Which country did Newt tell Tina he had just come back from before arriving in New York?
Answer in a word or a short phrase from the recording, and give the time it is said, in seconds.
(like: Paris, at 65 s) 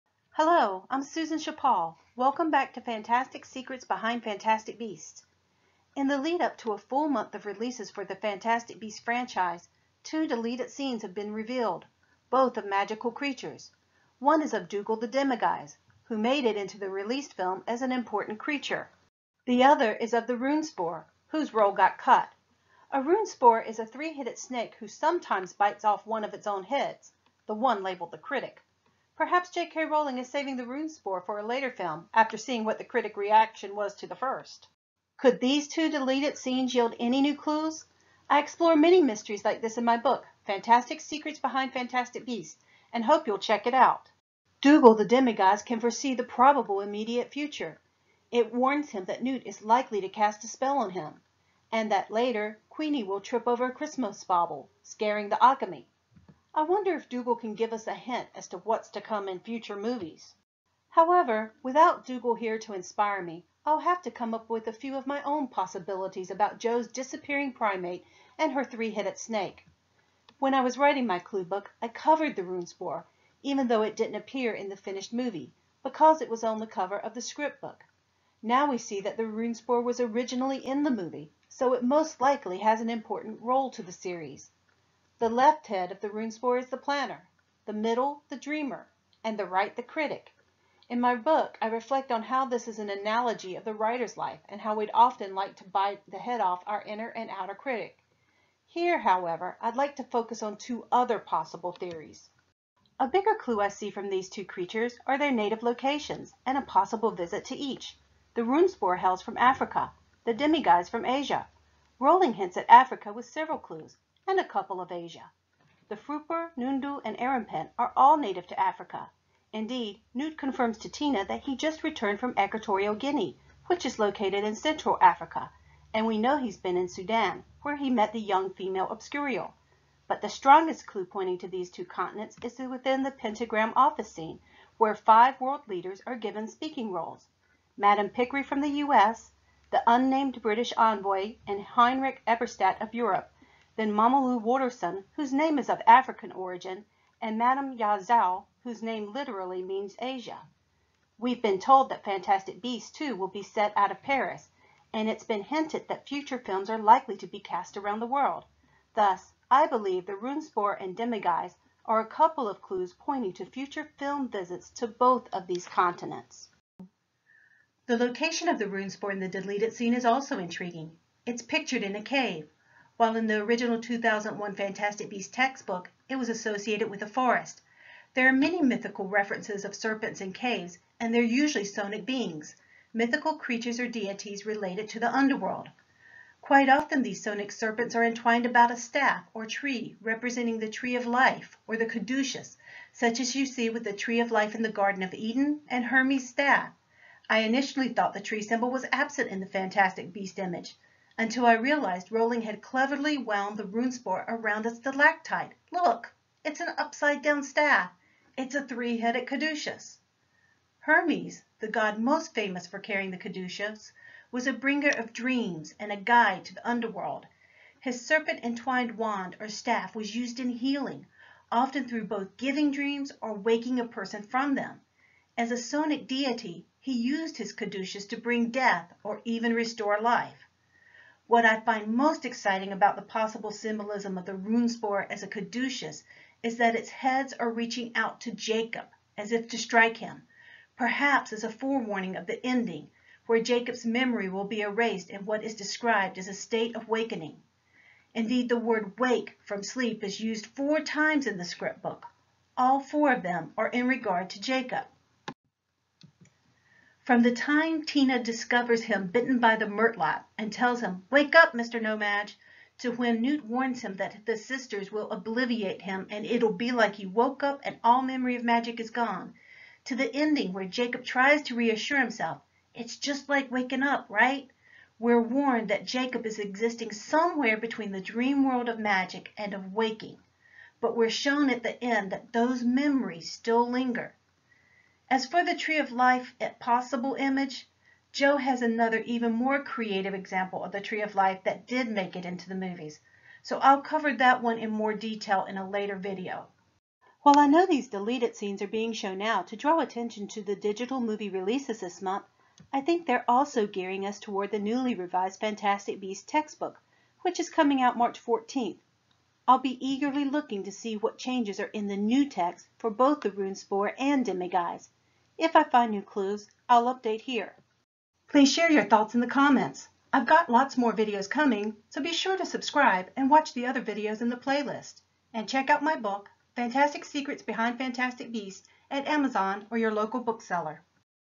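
Equatorial Guinea, at 122 s.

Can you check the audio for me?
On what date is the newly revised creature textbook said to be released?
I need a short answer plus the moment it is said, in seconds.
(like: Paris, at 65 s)
March 14th, at 307 s.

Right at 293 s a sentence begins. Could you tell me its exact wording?
So I'll cover that one in more detail in a later video.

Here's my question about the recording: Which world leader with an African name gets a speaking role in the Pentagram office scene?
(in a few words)
Momolu Wotorson.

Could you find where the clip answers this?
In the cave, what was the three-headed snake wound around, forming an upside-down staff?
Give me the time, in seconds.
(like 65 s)
204 s.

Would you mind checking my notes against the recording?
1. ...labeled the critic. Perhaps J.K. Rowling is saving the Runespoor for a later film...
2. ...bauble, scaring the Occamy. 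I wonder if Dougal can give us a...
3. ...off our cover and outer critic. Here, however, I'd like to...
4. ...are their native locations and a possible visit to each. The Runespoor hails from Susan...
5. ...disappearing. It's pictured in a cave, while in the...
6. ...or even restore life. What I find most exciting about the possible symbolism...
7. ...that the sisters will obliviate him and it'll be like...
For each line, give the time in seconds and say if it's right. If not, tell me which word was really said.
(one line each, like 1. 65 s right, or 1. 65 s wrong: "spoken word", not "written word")
1. 27 s right
2. 54 s right
3. 96 s wrong: "inner", not "cover"
4. 105 s wrong: "Africa", not "Susan"
5. 170 s wrong: "intriguing", not "disappearing"
6. 229 s right
7. 263 s right.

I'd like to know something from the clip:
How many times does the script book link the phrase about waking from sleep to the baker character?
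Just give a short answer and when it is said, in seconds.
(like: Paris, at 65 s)
4, at 250 s.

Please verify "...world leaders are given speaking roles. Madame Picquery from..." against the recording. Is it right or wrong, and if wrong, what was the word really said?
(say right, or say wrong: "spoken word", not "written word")
right.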